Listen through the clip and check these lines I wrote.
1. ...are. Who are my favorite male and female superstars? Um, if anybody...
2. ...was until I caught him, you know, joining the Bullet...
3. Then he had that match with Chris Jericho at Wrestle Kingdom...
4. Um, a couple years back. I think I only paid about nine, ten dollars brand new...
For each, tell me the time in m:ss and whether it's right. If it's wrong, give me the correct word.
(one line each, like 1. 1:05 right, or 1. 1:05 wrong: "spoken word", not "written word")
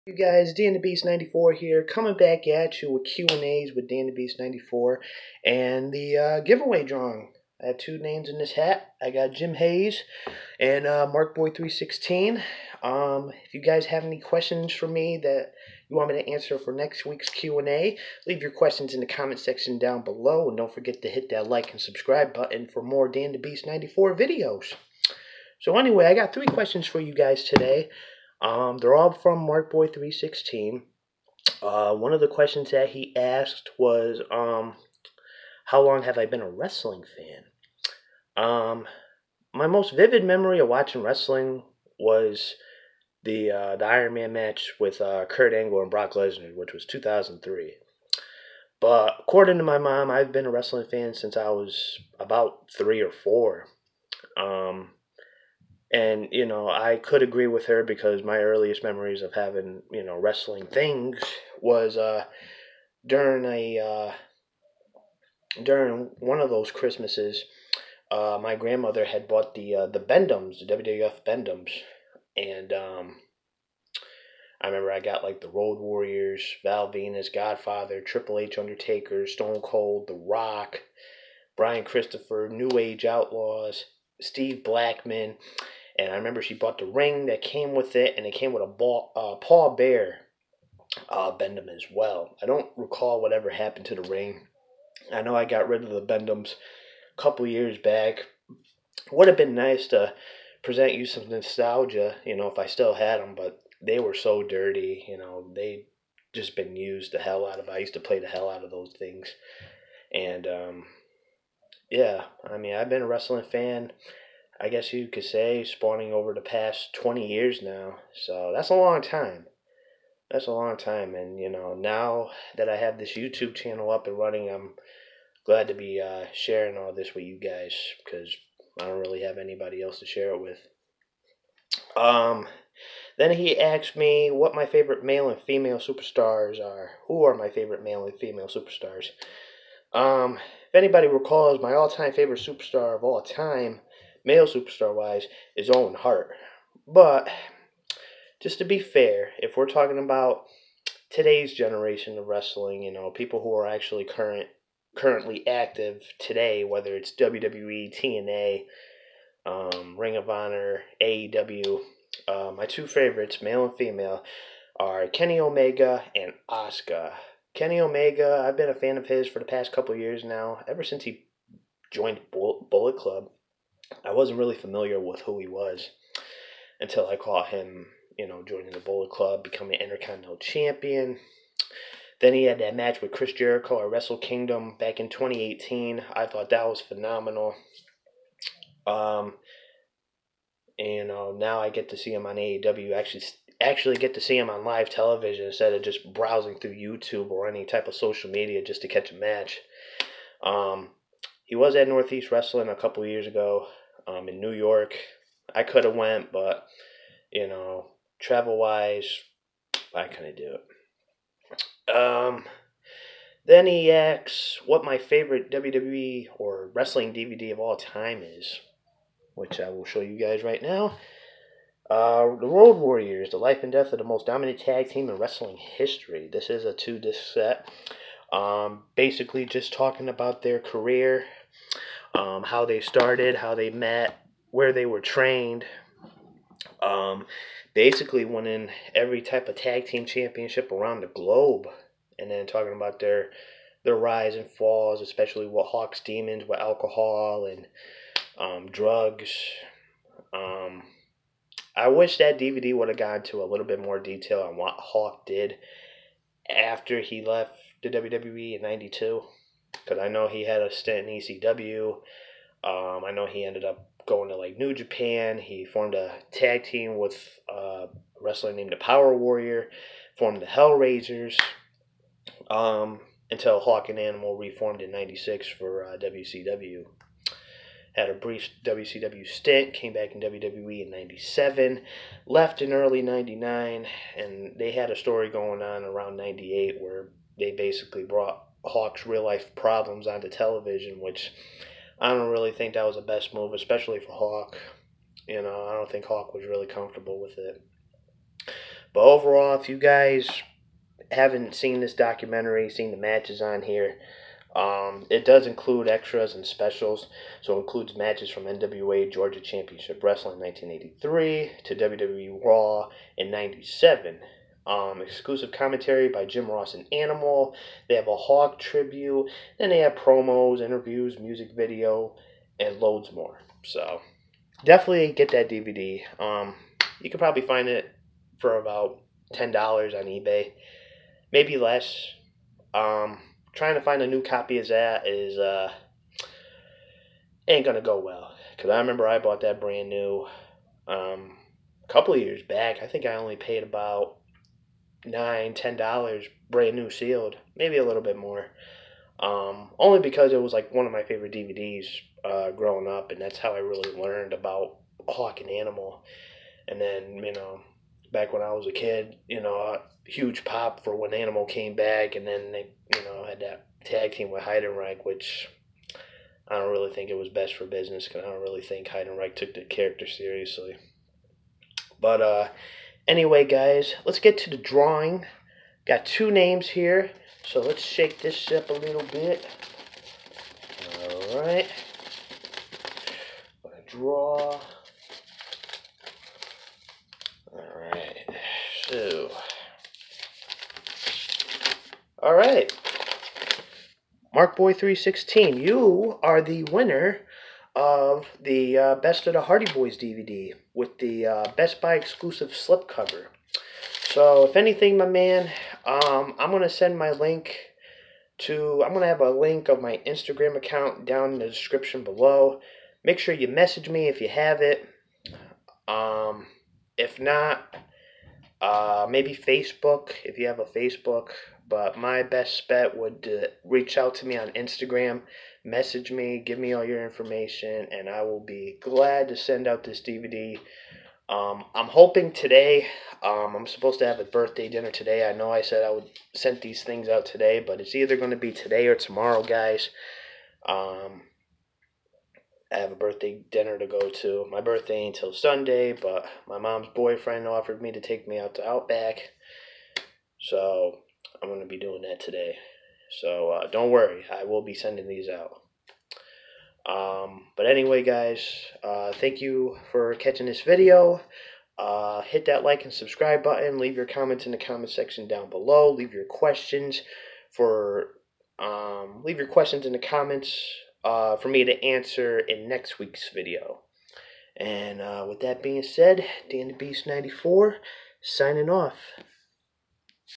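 1. 2:16 right
2. 2:55 right
3. 3:02 right
4. 5:40 right.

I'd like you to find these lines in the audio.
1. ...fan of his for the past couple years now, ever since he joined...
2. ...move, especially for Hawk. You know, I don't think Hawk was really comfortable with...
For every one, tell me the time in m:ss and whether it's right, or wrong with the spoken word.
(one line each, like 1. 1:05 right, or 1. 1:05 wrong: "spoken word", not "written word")
1. 2:48 right
2. 4:53 right.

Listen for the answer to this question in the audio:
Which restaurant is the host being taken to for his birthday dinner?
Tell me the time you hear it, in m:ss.
7:28.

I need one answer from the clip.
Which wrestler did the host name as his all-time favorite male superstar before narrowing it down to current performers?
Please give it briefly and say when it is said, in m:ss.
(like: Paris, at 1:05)
Owen Hart, at 2:25.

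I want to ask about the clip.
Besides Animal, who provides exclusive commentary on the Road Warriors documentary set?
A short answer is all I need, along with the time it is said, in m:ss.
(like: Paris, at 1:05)
Jim Ross, at 5:16.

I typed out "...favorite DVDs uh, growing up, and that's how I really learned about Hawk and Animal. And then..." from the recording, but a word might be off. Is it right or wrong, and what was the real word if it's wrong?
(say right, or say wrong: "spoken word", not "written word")
right.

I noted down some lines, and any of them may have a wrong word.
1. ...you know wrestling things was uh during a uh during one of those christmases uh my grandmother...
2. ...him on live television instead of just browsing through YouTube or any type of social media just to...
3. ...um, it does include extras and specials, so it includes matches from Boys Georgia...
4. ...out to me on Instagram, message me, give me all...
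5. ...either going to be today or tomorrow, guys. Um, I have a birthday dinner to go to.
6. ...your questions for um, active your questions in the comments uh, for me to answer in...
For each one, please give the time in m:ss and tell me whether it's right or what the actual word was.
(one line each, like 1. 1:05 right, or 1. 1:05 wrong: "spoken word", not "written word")
1. 0:59 right
2. 3:14 right
3. 5:04 wrong: "NWA", not "Boys"
4. 7:03 right
5. 7:17 right
6. 7:46 wrong: "leave", not "active".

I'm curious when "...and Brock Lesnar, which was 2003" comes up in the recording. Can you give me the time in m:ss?
0:45.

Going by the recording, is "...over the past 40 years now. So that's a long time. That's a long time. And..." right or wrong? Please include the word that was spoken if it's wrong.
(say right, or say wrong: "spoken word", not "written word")
wrong: "20", not "40".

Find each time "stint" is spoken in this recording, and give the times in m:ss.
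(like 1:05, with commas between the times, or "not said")
4:20, 4:39.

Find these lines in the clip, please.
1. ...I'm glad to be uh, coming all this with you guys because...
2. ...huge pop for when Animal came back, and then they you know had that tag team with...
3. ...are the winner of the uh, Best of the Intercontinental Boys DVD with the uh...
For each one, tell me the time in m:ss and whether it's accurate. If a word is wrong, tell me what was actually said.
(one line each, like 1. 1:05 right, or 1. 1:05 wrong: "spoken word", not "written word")
1. 2:04 wrong: "sharing", not "coming"
2. 6:00 right
3. 6:36 wrong: "Hardy", not "Intercontinental".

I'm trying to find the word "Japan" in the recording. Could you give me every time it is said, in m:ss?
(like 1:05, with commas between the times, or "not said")
4:24.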